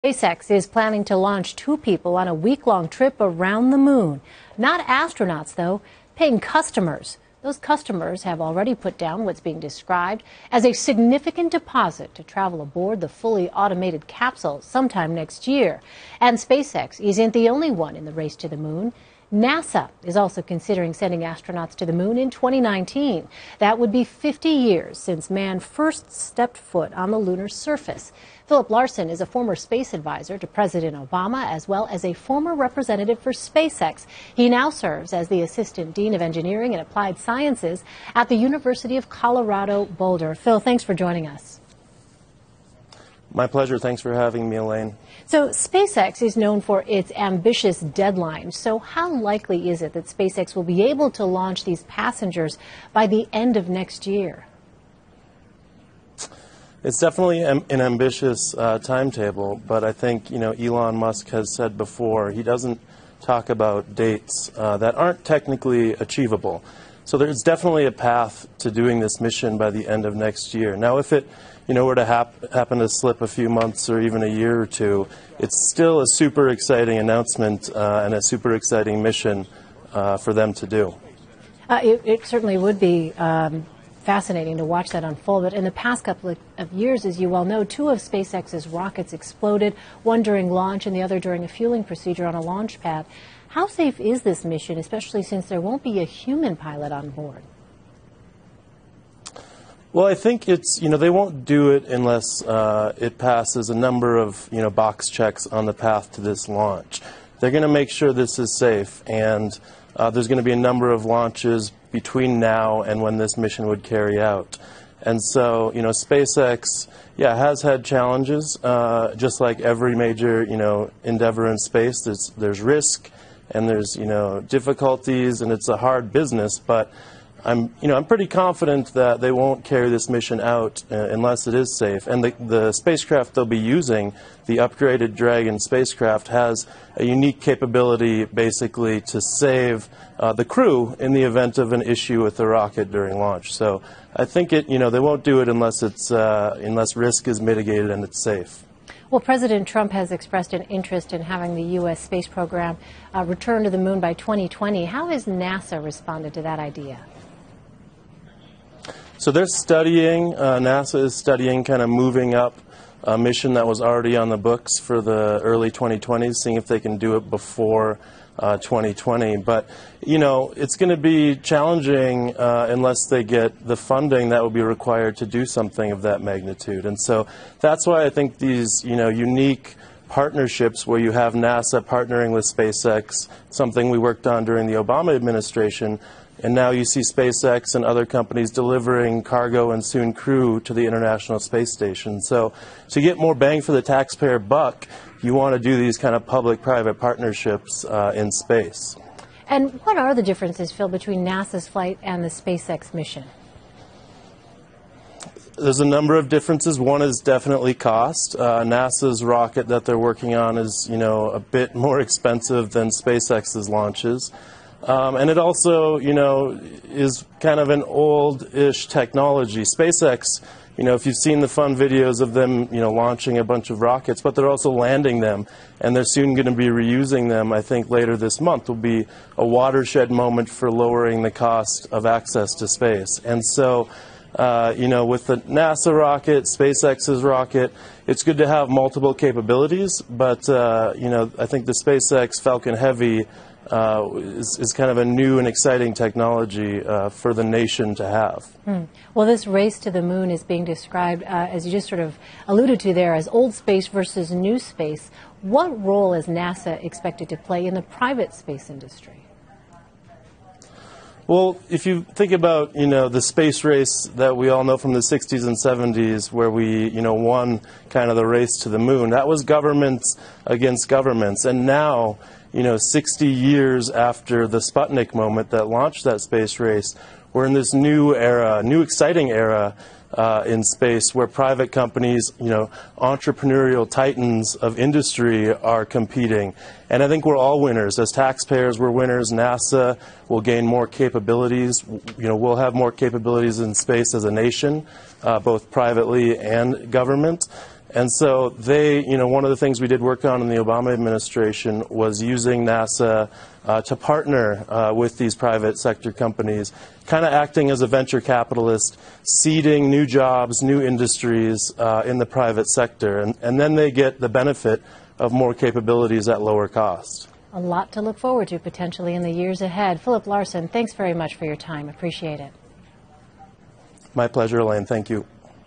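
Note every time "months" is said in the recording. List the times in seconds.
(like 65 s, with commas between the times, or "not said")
73 s, 228 s.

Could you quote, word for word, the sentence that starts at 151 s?
space program uh, return to the moon by 2020.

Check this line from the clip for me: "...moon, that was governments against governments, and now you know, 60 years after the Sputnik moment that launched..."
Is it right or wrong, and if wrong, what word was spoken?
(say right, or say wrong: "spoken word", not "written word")
right.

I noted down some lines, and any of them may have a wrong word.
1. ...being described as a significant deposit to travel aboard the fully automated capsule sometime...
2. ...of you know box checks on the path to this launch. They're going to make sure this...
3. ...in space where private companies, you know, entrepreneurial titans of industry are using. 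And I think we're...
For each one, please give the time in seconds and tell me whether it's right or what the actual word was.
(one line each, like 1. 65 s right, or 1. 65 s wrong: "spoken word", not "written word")
1. 9 s right
2. 104 s right
3. 280 s wrong: "competing", not "using".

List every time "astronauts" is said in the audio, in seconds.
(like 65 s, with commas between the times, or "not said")
4 s, 21 s.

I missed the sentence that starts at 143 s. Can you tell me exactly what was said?
So I think it, you know, they won't do it unless, it's, uh, unless risk is mitigated and it's safe.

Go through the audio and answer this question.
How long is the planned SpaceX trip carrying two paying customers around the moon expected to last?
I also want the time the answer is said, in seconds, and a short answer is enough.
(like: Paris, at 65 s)
A week, at 2 s.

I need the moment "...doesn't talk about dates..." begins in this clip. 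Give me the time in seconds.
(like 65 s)
62 s.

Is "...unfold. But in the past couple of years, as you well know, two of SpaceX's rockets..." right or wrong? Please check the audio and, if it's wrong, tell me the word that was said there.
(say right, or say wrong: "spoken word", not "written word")
right.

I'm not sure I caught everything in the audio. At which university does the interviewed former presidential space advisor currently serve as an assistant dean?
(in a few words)
University of Colorado Boulder.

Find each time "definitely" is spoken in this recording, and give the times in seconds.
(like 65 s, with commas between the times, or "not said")
56 s, 67 s, 207 s.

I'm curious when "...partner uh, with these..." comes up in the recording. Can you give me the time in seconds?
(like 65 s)
303 s.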